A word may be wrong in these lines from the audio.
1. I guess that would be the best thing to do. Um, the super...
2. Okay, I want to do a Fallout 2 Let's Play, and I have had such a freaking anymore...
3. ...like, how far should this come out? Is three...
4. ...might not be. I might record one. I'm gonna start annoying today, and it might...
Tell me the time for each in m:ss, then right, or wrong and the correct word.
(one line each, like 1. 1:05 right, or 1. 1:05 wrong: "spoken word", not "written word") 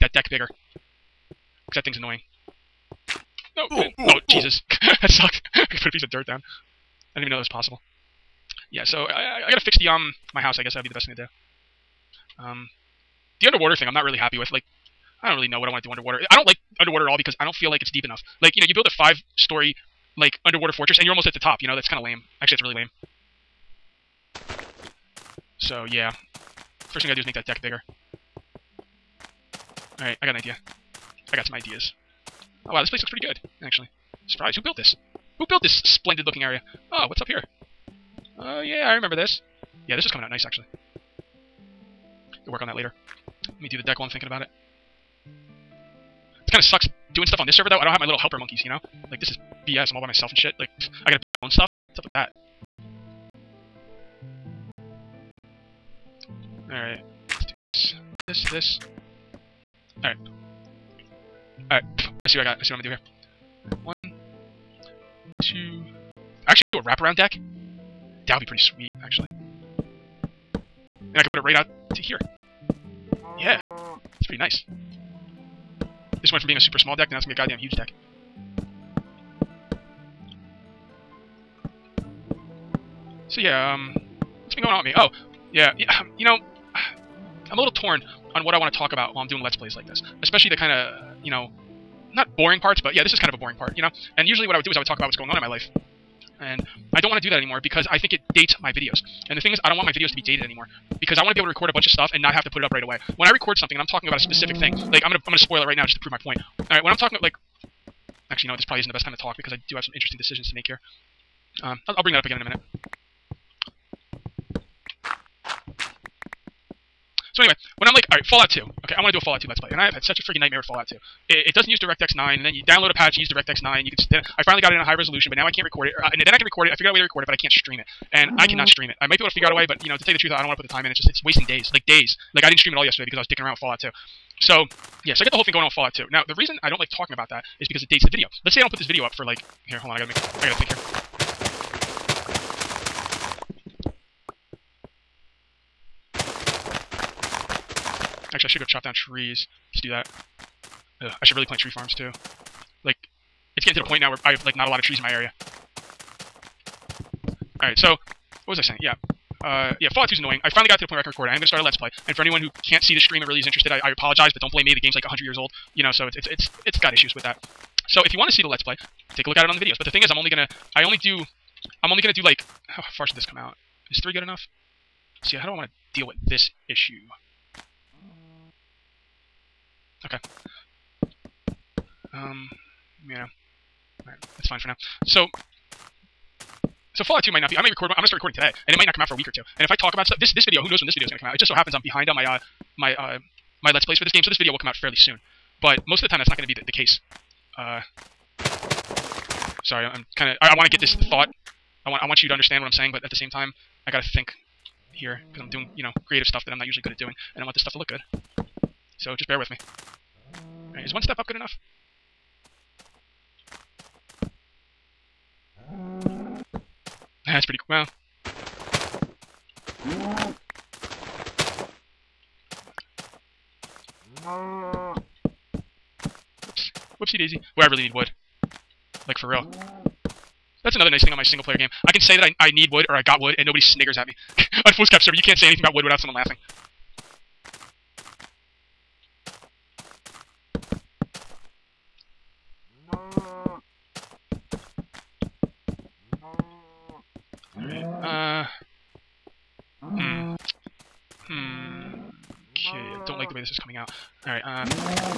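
1. 0:10 wrong: "underwater", not "super"
2. 1:58 wrong: "nightmare", not "anymore"
3. 2:52 right
4. 3:07 wrong: "recording", not "annoying".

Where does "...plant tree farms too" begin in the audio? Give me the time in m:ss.
2:31.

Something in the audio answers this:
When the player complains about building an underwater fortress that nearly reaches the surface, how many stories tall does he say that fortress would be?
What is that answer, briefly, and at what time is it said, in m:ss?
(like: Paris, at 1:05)
5, at 0:18.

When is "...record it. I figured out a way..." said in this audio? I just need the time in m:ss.
2:06.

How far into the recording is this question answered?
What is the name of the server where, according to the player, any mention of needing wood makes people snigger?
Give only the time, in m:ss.
3:54.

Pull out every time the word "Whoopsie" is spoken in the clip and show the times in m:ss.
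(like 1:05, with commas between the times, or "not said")
3:46.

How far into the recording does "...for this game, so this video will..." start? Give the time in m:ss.
3:13.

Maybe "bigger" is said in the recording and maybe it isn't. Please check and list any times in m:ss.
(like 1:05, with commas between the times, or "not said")
0:00, 0:27.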